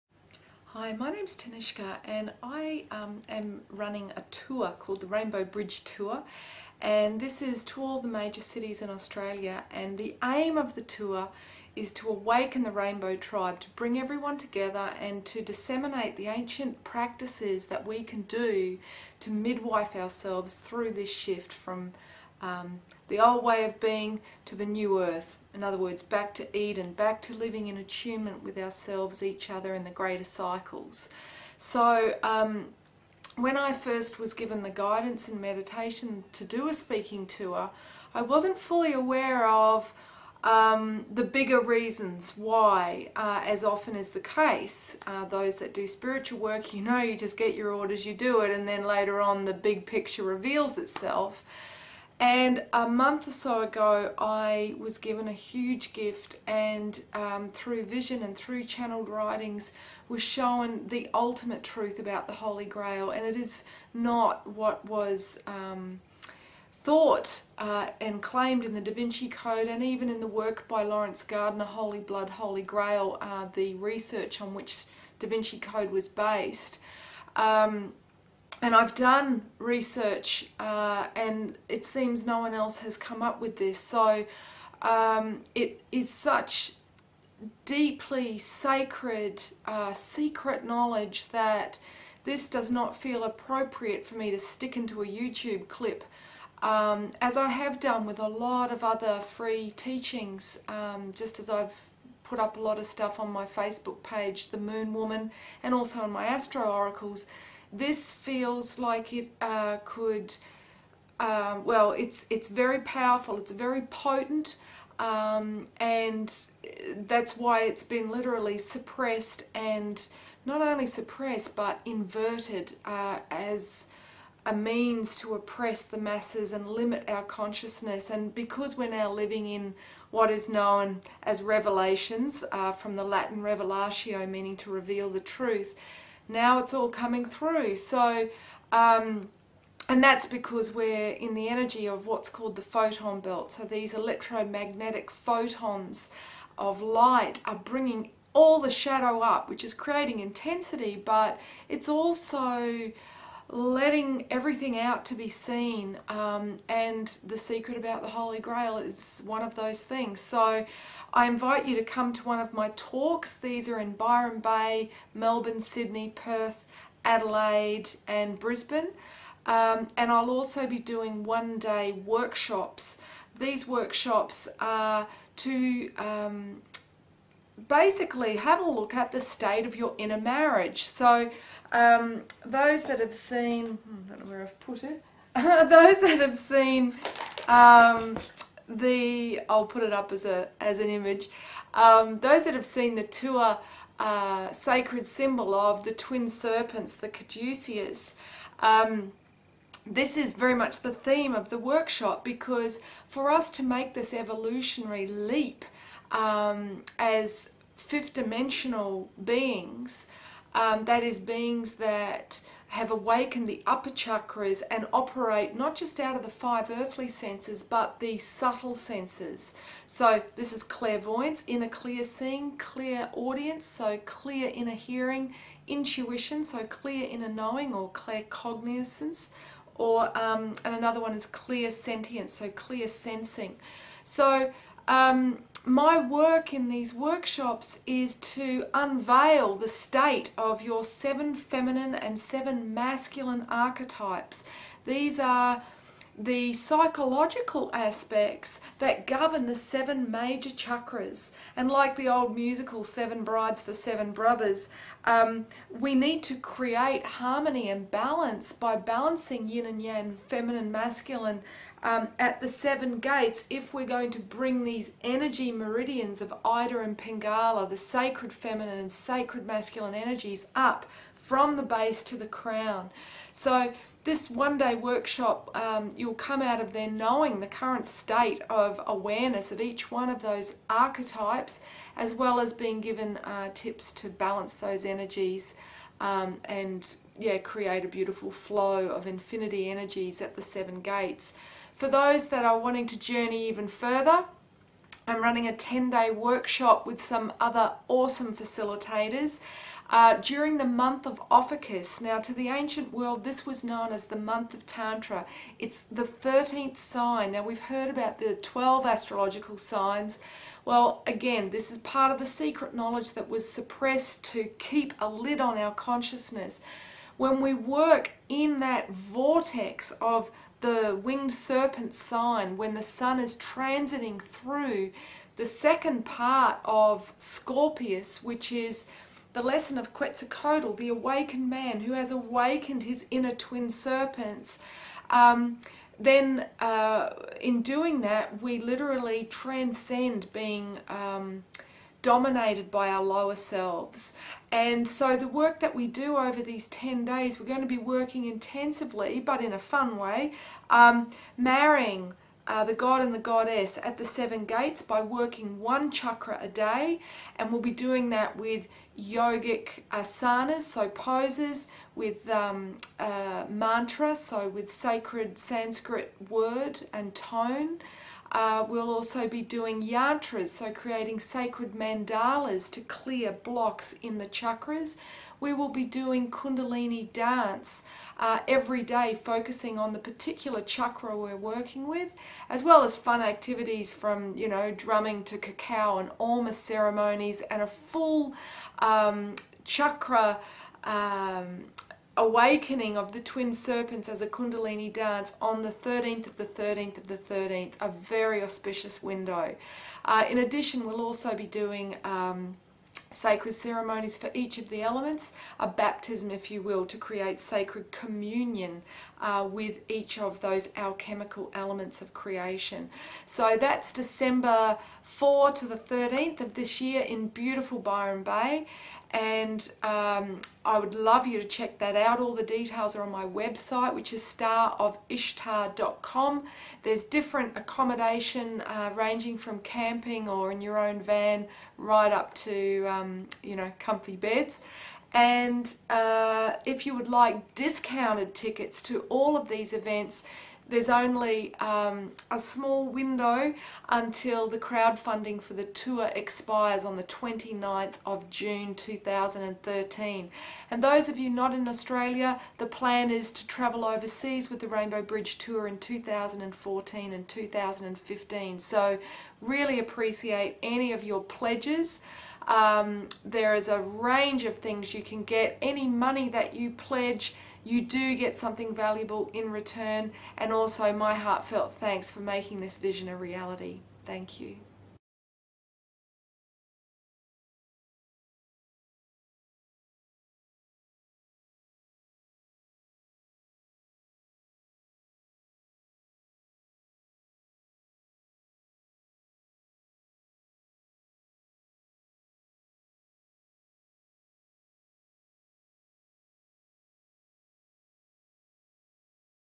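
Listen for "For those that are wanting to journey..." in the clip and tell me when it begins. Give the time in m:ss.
4:51.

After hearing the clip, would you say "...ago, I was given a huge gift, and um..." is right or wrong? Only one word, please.
right.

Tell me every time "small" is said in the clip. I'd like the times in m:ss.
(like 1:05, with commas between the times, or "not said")
7:22.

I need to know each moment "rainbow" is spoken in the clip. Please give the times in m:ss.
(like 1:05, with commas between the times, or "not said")
0:05, 0:12, 7:34.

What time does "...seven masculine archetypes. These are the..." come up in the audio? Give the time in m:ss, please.
4:02.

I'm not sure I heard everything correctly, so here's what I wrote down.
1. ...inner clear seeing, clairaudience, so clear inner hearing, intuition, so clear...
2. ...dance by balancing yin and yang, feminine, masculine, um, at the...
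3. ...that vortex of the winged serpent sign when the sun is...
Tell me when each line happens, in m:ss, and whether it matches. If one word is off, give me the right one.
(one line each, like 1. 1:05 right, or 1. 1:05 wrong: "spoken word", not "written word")
1. 3:41 right
2. 4:17 wrong: "balance", not "dance"
3. 5:18 right.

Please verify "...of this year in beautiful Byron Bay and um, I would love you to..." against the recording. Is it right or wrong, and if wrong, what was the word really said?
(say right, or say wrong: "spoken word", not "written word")
right.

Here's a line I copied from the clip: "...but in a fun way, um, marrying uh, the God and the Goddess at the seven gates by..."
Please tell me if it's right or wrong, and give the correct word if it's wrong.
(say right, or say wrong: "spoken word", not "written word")
right.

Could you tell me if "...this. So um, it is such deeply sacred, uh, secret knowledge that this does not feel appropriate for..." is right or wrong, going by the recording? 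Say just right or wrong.
right.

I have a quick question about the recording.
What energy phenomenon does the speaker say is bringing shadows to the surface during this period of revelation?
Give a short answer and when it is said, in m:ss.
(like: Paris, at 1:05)
photon belt, at 2:22.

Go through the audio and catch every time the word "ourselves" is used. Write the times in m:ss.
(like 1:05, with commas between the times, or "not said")
0:19, 0:28.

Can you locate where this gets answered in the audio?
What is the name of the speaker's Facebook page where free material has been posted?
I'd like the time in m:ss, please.
1:44.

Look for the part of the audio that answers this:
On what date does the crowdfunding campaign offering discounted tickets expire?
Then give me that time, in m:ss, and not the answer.
7:27.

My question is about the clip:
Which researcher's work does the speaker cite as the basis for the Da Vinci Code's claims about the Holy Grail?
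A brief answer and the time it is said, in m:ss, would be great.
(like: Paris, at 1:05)
Laurence Gardner, at 1:10.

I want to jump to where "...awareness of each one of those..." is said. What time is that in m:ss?
4:38.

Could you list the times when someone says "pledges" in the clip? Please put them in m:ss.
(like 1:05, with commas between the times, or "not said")
7:41, 7:46.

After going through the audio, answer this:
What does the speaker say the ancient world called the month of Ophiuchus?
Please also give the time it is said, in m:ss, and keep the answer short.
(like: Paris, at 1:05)
month of Tantra, at 5:04.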